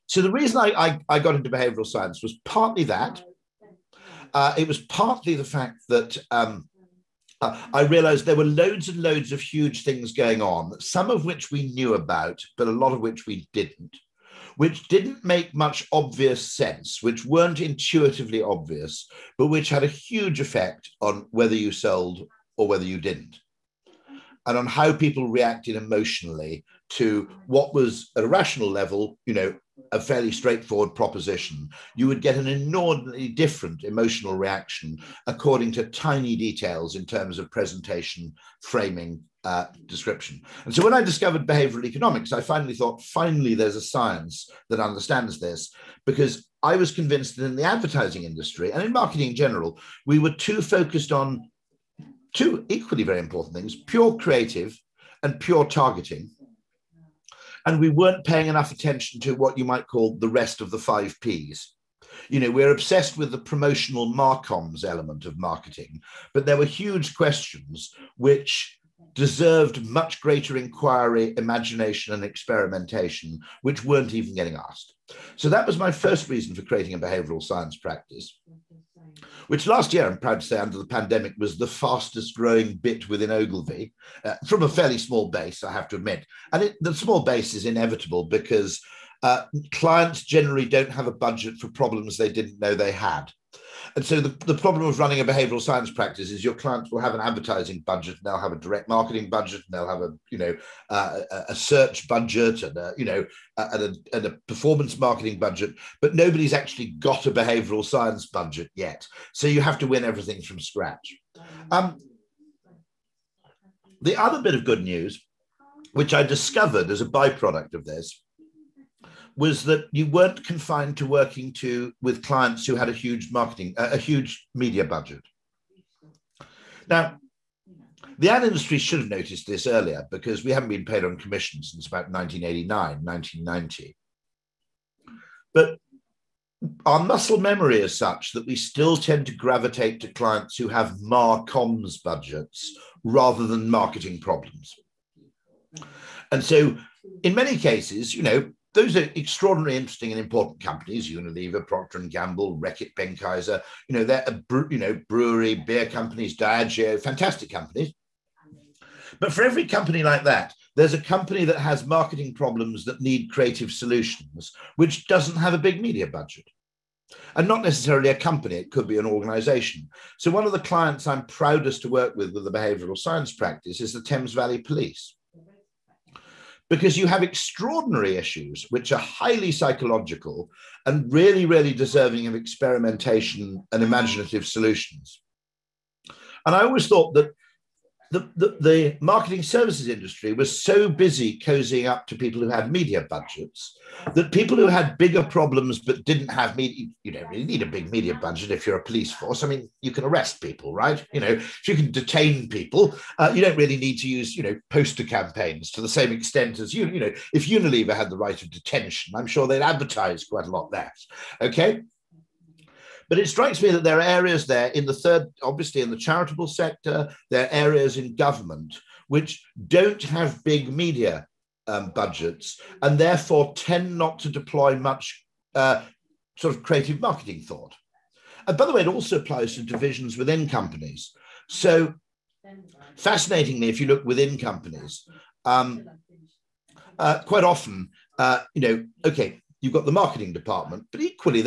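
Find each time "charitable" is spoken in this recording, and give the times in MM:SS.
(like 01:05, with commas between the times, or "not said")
03:35.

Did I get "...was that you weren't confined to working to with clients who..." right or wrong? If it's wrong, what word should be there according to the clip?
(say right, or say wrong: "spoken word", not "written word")
right.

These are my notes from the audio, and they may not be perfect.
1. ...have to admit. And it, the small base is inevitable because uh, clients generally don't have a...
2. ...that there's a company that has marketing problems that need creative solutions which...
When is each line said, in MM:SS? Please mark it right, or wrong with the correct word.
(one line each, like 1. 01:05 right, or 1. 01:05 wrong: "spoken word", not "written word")
1. 01:25 right
2. 02:40 right.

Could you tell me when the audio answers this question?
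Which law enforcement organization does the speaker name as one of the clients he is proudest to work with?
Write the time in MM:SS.
02:54.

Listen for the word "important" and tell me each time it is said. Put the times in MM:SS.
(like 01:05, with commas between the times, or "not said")
00:53, 02:30.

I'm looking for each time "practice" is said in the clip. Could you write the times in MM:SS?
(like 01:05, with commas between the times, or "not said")
01:17, 01:35, 02:53.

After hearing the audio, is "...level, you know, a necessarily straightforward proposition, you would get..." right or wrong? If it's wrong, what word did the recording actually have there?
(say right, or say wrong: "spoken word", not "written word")
wrong: "fairly", not "necessarily".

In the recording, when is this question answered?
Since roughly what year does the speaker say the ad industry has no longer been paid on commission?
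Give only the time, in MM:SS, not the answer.
02:12.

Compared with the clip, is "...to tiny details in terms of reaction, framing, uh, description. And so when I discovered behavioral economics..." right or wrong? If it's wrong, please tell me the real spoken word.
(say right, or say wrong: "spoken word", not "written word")
wrong: "presentation", not "reaction".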